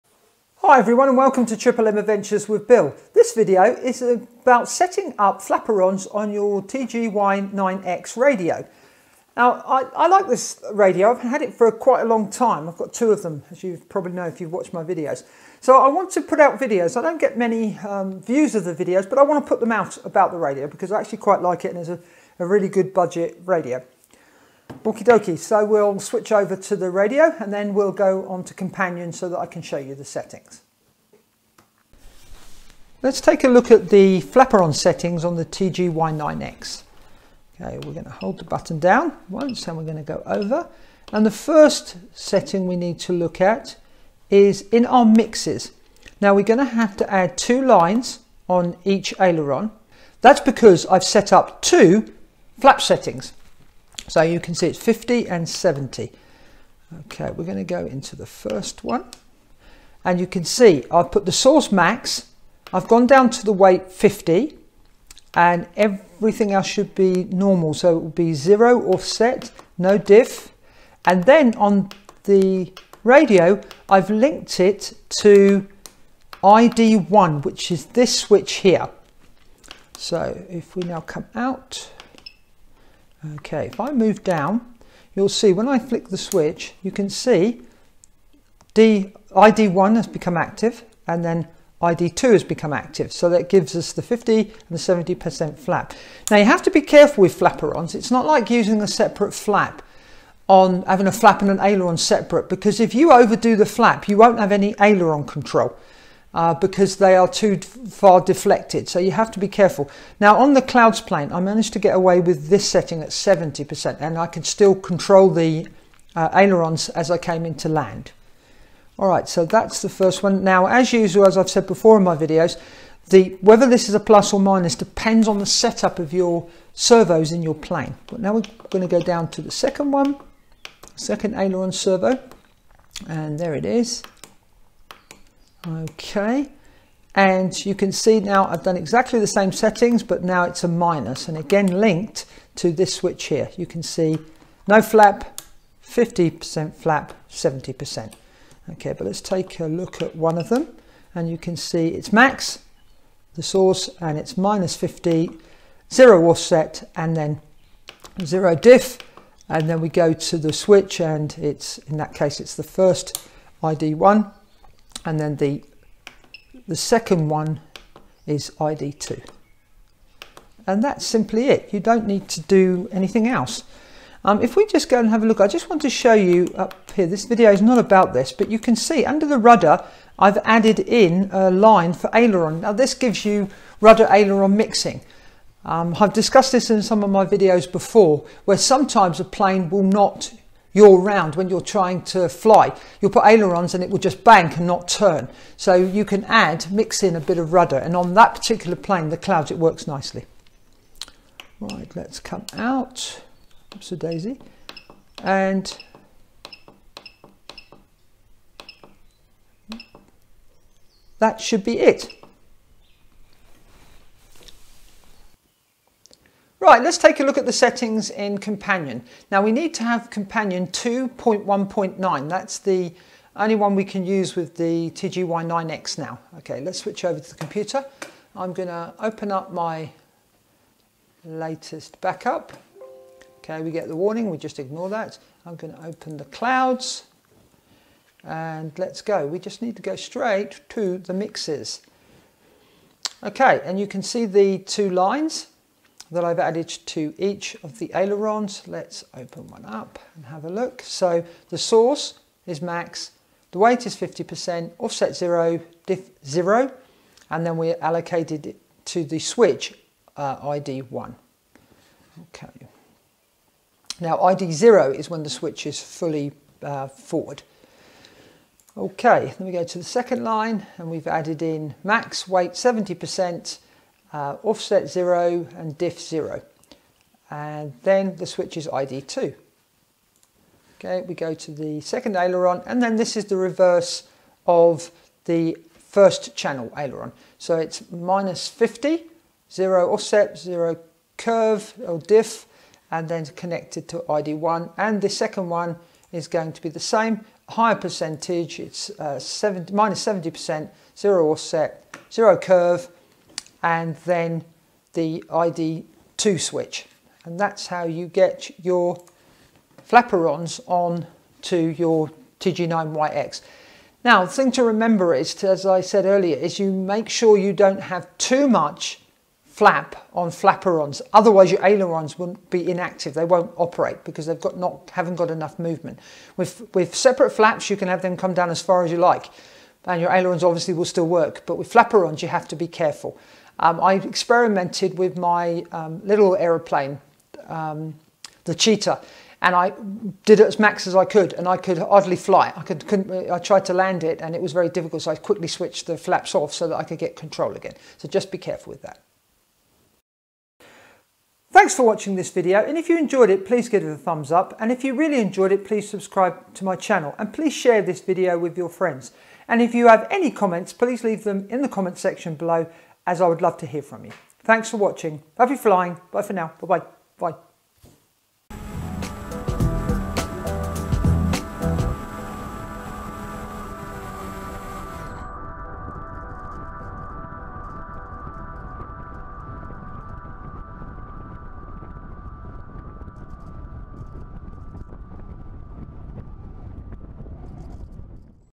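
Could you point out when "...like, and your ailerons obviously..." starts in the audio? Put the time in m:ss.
5:28.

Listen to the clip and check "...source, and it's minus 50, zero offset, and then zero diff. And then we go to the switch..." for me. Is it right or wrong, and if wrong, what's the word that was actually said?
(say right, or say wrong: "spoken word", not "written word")
right.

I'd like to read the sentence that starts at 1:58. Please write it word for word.
All right, so that's the first one.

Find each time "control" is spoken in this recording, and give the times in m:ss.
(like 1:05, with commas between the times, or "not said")
1:45, 1:54, 5:47.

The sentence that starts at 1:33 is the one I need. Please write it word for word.
So that gives us the 50 and the 70% flap.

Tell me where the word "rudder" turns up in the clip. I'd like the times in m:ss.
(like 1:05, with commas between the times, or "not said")
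2:59, 3:03, 3:17.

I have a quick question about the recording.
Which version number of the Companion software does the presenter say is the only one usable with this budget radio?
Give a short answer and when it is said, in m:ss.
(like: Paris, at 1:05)
2.1.9, at 3:40.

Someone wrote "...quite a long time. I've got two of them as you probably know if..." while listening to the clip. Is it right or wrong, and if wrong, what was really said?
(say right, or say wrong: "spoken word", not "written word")
right.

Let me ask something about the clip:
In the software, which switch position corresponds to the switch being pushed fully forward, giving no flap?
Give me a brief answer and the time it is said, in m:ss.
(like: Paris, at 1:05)
ID0, at 4:24.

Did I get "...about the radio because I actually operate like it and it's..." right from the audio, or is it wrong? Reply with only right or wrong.
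wrong.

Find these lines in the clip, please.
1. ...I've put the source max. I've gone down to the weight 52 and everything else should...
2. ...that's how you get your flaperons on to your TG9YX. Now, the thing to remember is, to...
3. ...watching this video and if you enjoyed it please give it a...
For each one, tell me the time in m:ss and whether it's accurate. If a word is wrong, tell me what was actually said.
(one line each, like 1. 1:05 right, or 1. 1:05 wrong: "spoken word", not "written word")
1. 1:00 wrong: "50", not "52"
2. 5:07 right
3. 5:51 right.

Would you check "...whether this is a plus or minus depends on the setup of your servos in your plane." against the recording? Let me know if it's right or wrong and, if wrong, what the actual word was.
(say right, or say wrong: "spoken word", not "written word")
right.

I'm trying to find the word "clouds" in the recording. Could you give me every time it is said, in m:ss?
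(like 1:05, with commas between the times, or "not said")
1:50, 3:19, 3:56.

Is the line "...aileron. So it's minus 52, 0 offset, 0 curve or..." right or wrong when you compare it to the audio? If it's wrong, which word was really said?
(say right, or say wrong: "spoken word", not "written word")
wrong: "50", not "52".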